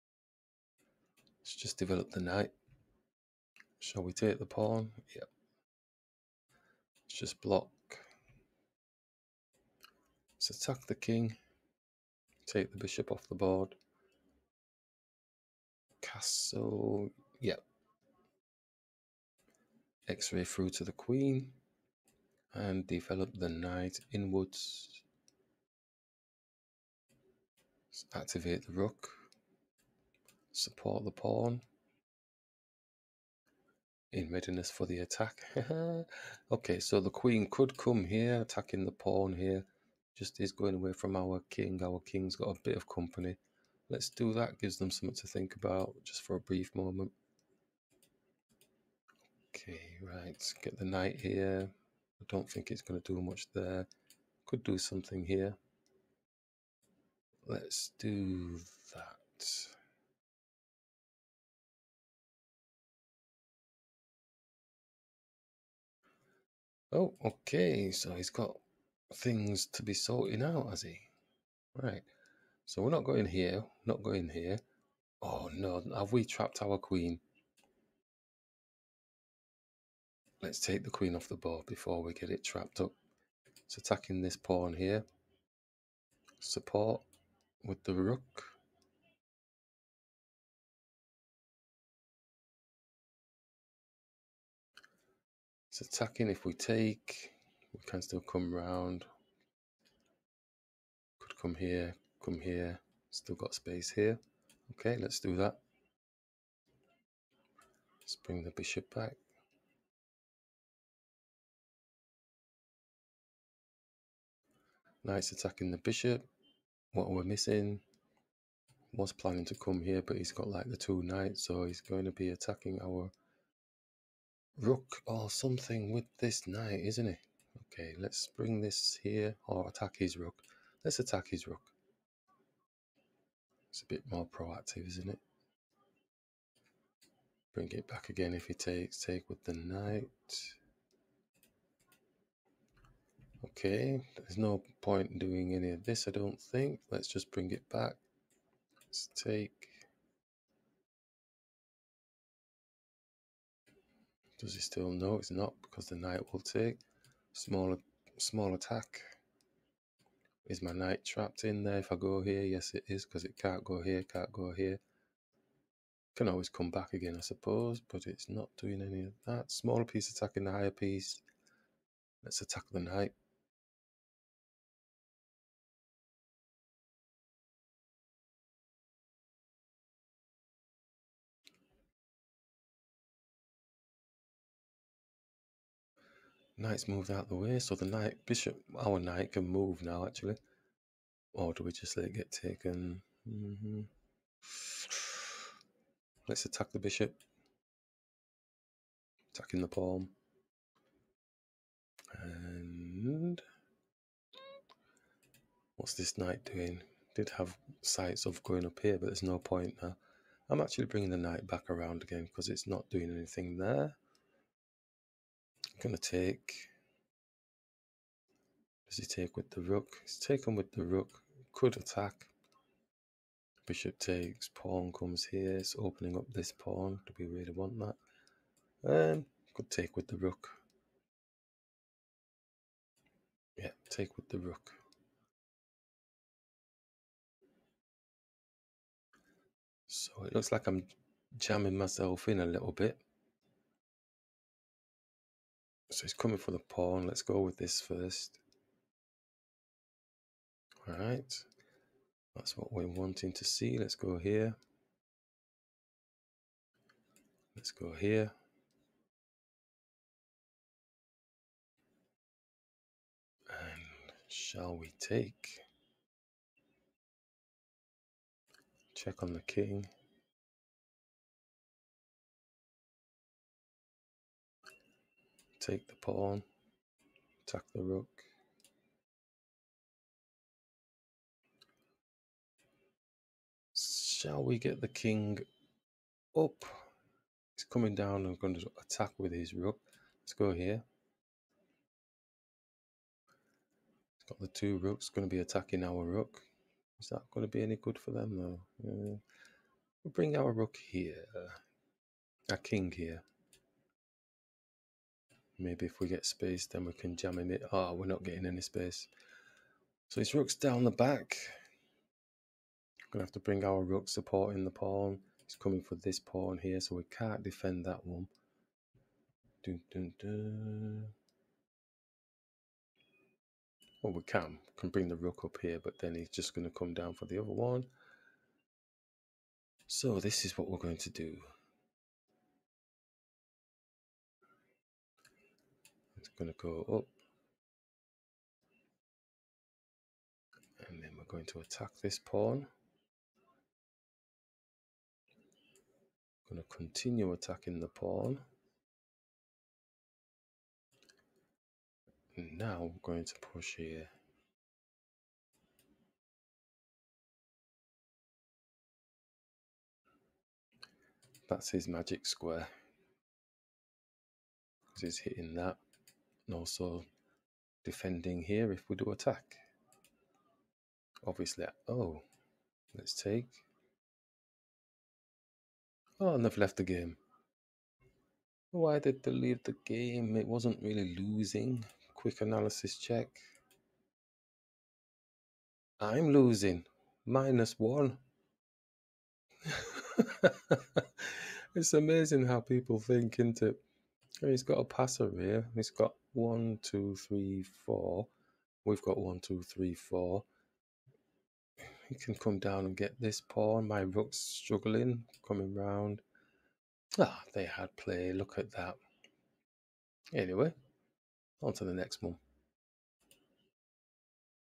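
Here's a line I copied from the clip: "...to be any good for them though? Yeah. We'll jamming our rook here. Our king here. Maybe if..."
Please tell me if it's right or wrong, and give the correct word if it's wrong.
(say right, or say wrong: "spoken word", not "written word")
wrong: "bring", not "jamming".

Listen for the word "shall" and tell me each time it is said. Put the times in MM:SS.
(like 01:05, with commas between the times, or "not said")
00:03, 04:24, 04:43.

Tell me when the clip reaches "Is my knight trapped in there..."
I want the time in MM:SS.
02:40.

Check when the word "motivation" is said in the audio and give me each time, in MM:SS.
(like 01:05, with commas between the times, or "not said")
not said.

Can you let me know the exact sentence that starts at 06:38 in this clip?
We've got one, two, three, four.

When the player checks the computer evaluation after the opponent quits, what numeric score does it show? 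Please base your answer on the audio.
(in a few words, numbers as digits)
-1.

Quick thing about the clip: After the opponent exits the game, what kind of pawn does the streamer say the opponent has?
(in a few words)
passer.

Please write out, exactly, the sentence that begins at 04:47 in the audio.
He's coming down and going to attack with his rook.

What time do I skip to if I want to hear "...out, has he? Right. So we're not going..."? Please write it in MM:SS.
01:10.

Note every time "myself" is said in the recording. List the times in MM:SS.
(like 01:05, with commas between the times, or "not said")
04:01.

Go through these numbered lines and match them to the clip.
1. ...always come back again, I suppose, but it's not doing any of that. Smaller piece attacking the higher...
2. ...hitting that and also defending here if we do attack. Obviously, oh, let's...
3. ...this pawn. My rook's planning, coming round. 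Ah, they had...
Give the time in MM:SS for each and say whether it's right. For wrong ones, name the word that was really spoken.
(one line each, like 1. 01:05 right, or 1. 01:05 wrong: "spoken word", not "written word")
1. 02:46 right
2. 06:05 right
3. 06:43 wrong: "struggling", not "planning".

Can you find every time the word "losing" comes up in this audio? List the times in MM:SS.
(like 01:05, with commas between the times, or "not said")
06:21, 06:26.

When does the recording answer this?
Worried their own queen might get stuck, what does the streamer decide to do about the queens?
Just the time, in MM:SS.
01:20.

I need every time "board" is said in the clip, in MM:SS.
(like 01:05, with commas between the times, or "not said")
00:13, 01:21.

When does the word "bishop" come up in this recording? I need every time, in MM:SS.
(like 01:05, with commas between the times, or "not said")
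00:12, 01:48, 01:55, 03:08, 03:16, 03:43.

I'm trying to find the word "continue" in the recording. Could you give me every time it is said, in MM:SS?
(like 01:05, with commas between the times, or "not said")
05:46.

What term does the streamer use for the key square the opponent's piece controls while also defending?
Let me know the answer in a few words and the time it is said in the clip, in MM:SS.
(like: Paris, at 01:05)
magic square, at 06:01.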